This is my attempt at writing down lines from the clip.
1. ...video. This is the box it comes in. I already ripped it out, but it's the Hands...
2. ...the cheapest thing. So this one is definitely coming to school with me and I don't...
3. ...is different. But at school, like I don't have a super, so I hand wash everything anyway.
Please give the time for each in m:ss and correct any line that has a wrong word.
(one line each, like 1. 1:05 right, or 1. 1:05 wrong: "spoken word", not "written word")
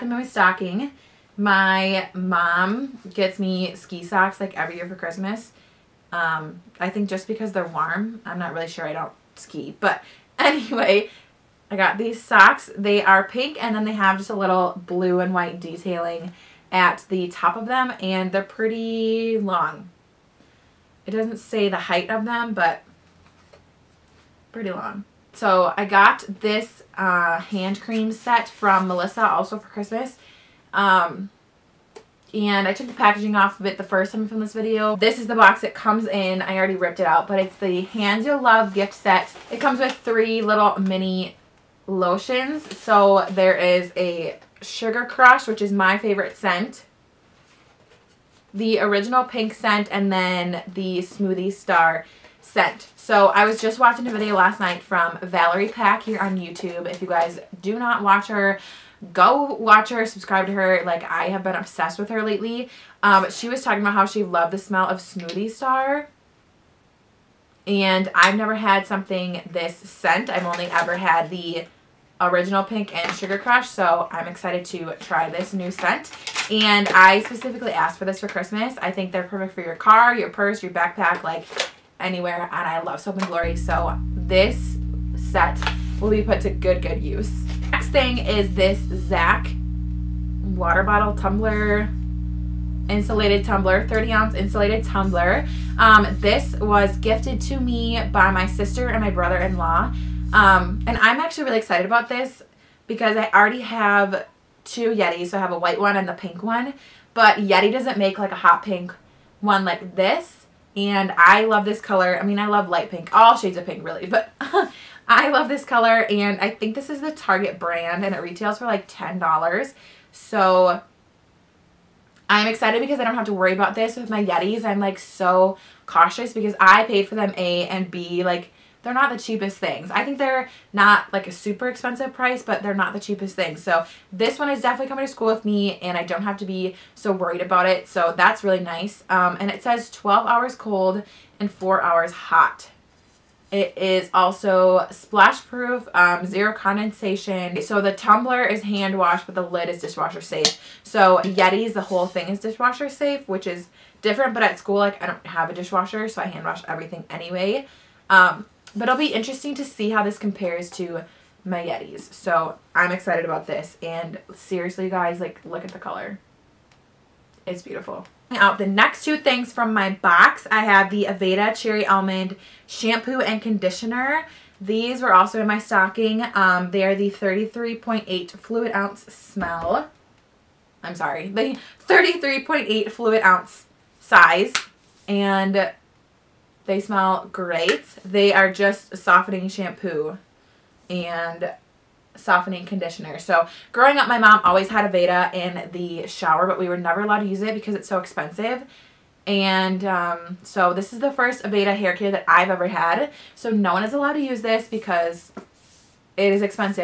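1. 0:34 right
2. 2:12 right
3. 2:33 wrong: "dishwasher", not "super".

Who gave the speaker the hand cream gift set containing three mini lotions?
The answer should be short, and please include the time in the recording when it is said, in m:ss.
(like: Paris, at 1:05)
Melissa, at 0:28.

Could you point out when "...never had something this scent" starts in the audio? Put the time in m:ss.
1:08.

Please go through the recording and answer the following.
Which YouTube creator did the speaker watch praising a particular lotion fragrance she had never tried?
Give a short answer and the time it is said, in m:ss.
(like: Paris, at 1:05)
Valerie Pac, at 0:55.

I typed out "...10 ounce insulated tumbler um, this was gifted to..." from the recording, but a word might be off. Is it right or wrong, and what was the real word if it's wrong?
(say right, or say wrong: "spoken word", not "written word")
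wrong: "30", not "10".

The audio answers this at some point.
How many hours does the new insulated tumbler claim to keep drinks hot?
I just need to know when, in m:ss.
2:21.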